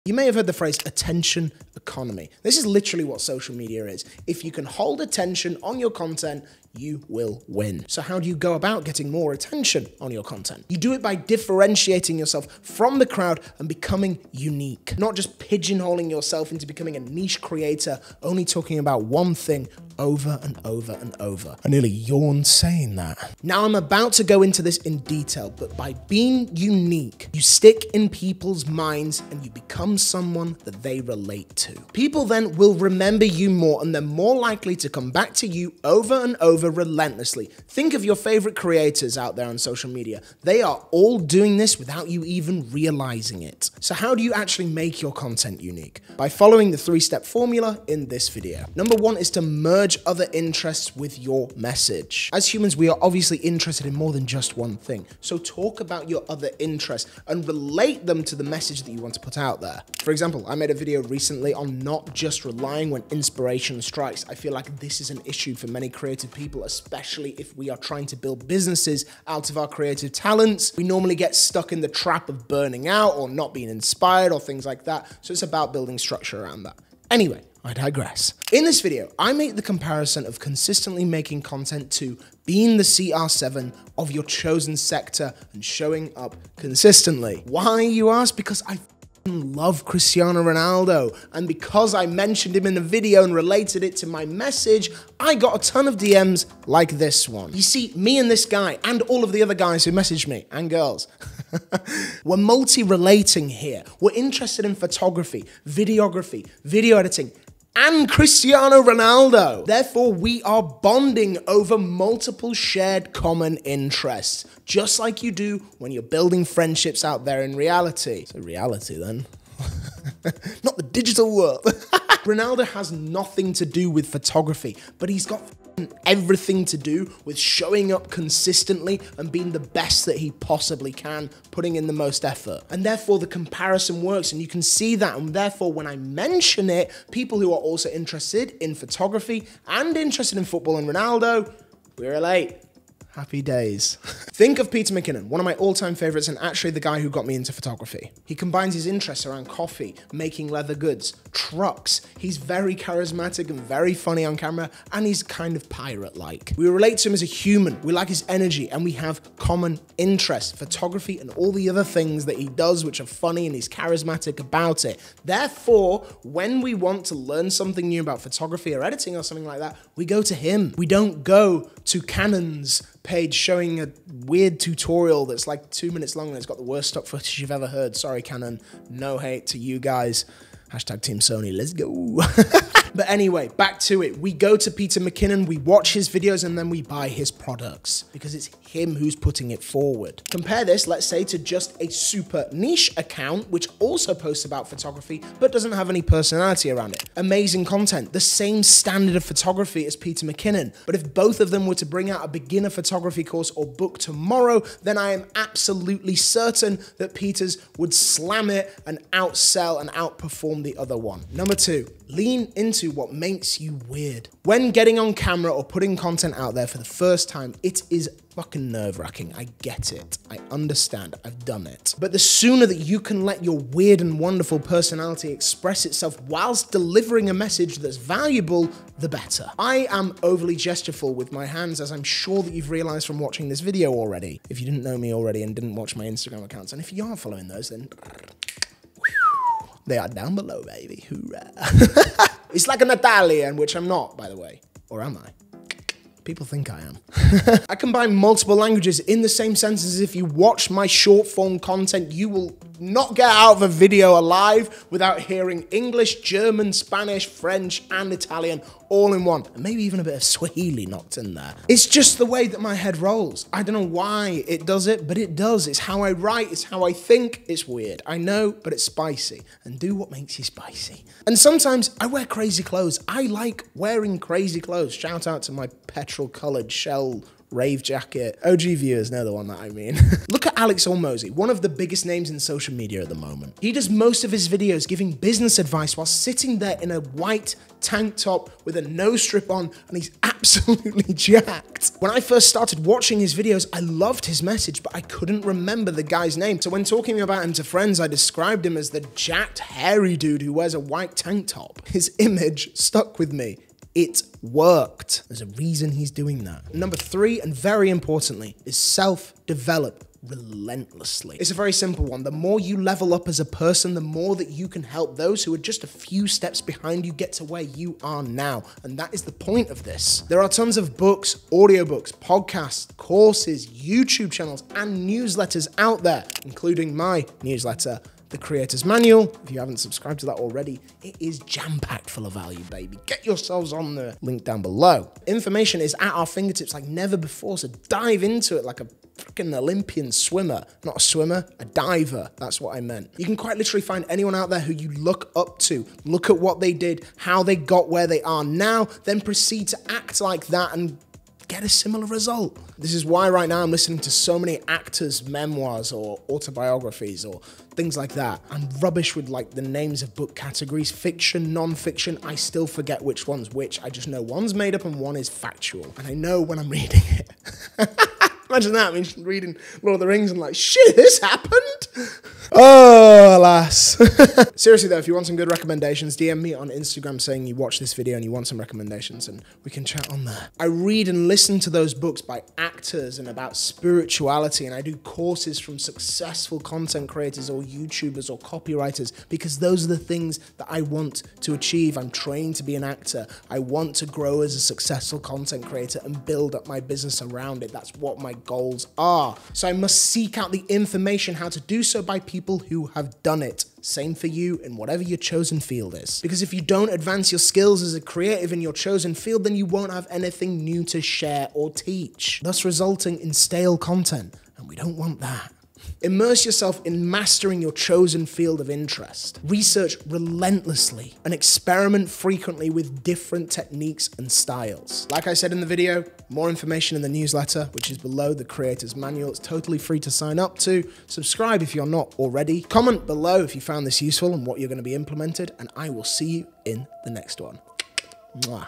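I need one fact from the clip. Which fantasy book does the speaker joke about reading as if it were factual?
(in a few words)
Lord of the Rings.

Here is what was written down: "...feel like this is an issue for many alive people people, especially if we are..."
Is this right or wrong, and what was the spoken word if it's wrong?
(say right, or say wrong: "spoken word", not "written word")
wrong: "creative", not "alive".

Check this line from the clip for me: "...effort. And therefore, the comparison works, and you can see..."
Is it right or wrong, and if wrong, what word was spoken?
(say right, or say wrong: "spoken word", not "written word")
right.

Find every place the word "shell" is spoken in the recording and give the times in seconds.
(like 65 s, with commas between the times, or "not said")
276 s.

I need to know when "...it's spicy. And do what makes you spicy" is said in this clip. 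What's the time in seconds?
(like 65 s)
268 s.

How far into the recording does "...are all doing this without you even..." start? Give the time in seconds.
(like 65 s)
40 s.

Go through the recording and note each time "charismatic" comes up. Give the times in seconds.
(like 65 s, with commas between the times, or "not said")
152 s, 163 s.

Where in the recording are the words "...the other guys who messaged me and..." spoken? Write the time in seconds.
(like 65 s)
99 s.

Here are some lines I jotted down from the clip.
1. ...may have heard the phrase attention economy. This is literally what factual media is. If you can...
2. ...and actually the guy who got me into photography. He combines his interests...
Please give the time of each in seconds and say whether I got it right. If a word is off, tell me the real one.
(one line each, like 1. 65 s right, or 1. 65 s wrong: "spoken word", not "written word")
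1. 0 s wrong: "social", not "factual"
2. 146 s right.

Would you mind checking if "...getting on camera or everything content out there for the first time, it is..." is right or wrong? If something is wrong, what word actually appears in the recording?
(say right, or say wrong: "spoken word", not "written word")
wrong: "putting", not "everything".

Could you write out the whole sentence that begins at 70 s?
We normally get stuck in the trap of burning out or not being inspired or things like that.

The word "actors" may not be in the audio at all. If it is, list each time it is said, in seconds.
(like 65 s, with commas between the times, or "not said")
354 s, 382 s, 392 s.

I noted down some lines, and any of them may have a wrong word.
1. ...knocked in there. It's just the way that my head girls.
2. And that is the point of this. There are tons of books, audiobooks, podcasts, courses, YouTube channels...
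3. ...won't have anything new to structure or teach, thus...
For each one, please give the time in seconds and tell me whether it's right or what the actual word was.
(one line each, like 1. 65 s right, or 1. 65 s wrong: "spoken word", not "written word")
1. 260 s wrong: "rolls", not "girls"
2. 318 s right
3. 409 s wrong: "share", not "structure".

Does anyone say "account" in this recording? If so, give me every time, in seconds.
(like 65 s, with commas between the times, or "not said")
192 s, 236 s.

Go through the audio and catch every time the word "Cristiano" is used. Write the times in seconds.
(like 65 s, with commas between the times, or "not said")
89 s, 108 s.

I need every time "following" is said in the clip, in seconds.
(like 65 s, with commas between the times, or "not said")
46 s, 237 s.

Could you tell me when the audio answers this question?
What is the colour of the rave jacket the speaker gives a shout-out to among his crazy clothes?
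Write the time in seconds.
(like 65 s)
275 s.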